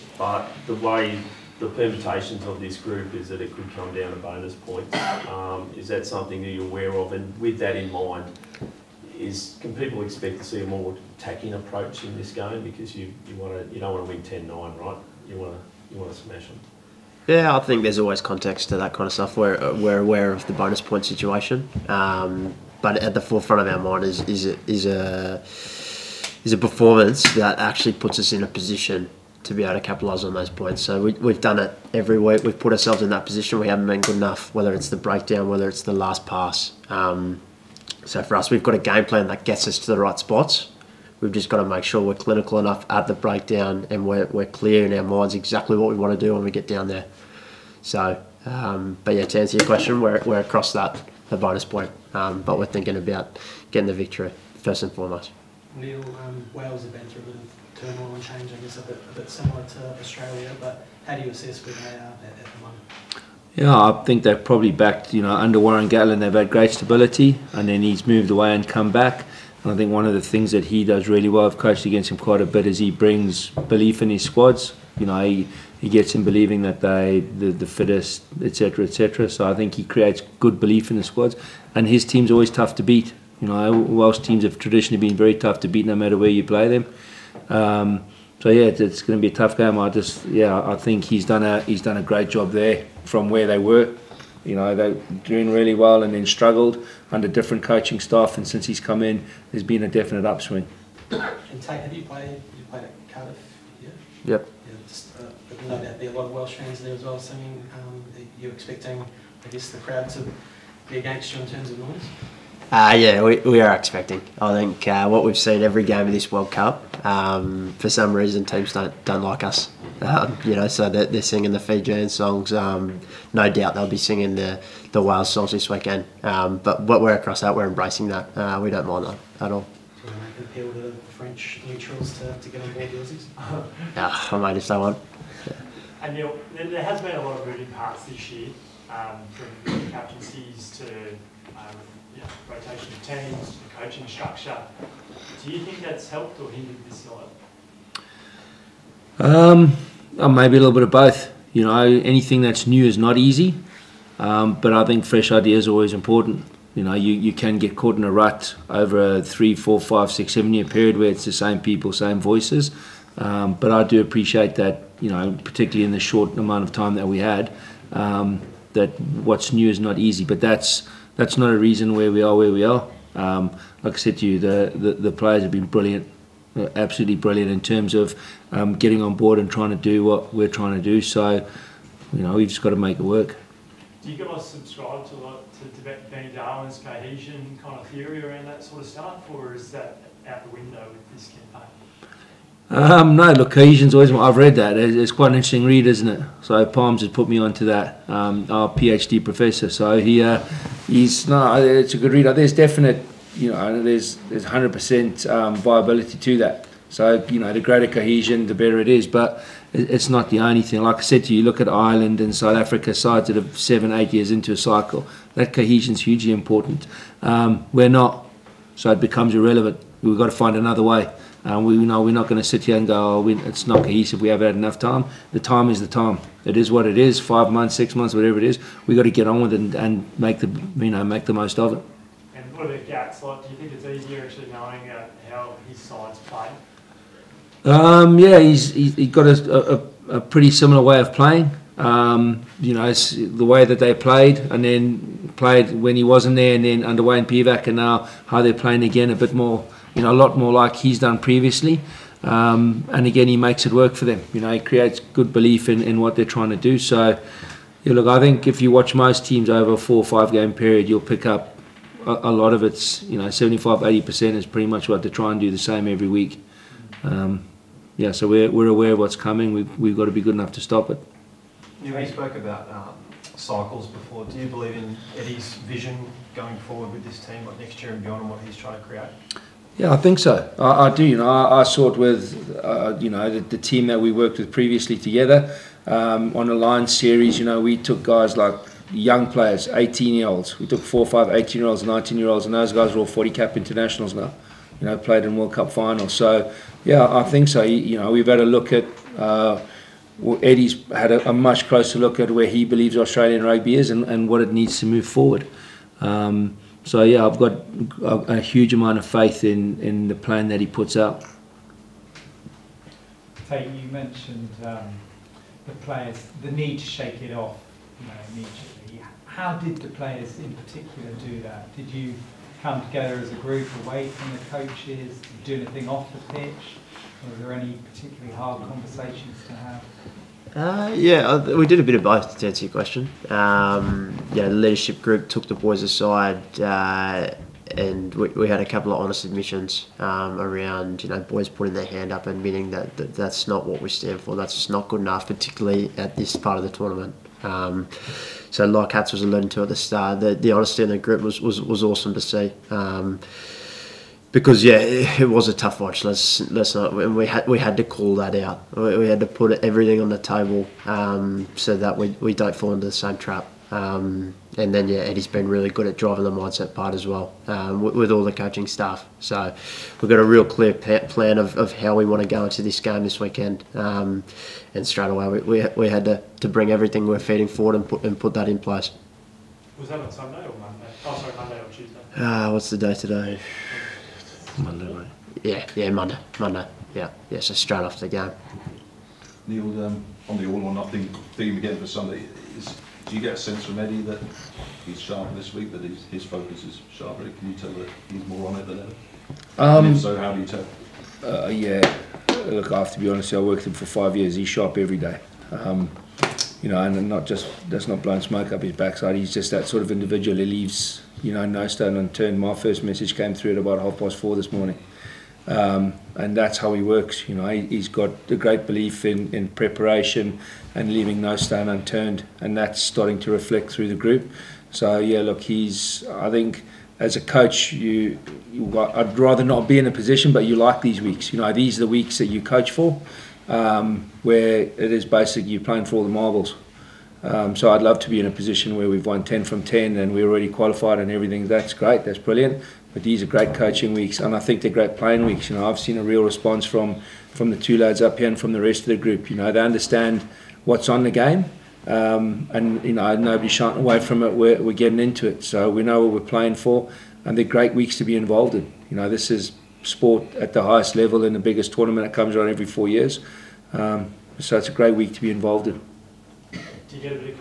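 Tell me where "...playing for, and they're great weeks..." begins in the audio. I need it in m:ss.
7:36.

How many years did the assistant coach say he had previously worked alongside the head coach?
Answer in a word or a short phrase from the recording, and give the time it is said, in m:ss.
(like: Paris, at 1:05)
5, at 6:43.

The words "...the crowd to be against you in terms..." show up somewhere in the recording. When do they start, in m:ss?
1:49.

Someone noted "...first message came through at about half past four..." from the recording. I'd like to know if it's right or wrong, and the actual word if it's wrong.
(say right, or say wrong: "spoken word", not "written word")
right.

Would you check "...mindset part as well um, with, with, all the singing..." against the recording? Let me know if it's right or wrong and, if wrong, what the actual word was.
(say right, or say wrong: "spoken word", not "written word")
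wrong: "coaching", not "singing".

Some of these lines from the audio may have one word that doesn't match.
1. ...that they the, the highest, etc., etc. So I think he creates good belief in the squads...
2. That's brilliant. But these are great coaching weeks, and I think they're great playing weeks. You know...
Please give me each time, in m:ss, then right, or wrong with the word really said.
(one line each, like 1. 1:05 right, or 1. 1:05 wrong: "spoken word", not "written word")
1. 1:16 wrong: "fittest", not "highest"
2. 7:22 right.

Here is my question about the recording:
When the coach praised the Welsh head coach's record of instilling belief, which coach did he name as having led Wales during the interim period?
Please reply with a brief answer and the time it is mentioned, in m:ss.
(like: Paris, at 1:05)
Wayne Pivac, at 4:07.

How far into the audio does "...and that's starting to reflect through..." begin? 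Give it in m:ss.
7:02.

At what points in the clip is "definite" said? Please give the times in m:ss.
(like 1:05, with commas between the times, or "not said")
1:39, 3:22.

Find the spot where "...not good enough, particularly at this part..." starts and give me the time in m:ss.
5:44.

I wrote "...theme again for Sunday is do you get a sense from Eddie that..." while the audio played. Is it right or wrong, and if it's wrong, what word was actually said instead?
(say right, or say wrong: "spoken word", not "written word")
right.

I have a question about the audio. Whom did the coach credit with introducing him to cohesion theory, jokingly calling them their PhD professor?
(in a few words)
Palms.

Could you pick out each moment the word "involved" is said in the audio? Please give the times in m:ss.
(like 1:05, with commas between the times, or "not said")
7:38, 7:45.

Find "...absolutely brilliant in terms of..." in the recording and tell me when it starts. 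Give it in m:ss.
2:56.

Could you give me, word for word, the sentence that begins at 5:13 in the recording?
Tate, you mentioned um, the players, the need to shake it off you know, immediately.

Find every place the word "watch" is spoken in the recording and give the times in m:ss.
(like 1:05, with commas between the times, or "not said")
4:18, 5:55.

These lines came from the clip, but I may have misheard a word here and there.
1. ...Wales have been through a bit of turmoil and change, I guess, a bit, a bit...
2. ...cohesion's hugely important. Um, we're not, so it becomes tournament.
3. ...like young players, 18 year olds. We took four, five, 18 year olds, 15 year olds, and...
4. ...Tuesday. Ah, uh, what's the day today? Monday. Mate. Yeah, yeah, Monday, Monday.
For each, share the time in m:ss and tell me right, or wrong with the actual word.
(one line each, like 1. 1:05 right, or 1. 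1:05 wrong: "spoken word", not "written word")
1. 0:56 right
2. 3:35 wrong: "irrelevant", not "tournament"
3. 4:48 wrong: "19", not "15"
4. 6:21 right.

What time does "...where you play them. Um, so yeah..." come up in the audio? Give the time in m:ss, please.
1:26.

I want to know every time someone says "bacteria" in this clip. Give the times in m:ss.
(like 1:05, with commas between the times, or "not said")
not said.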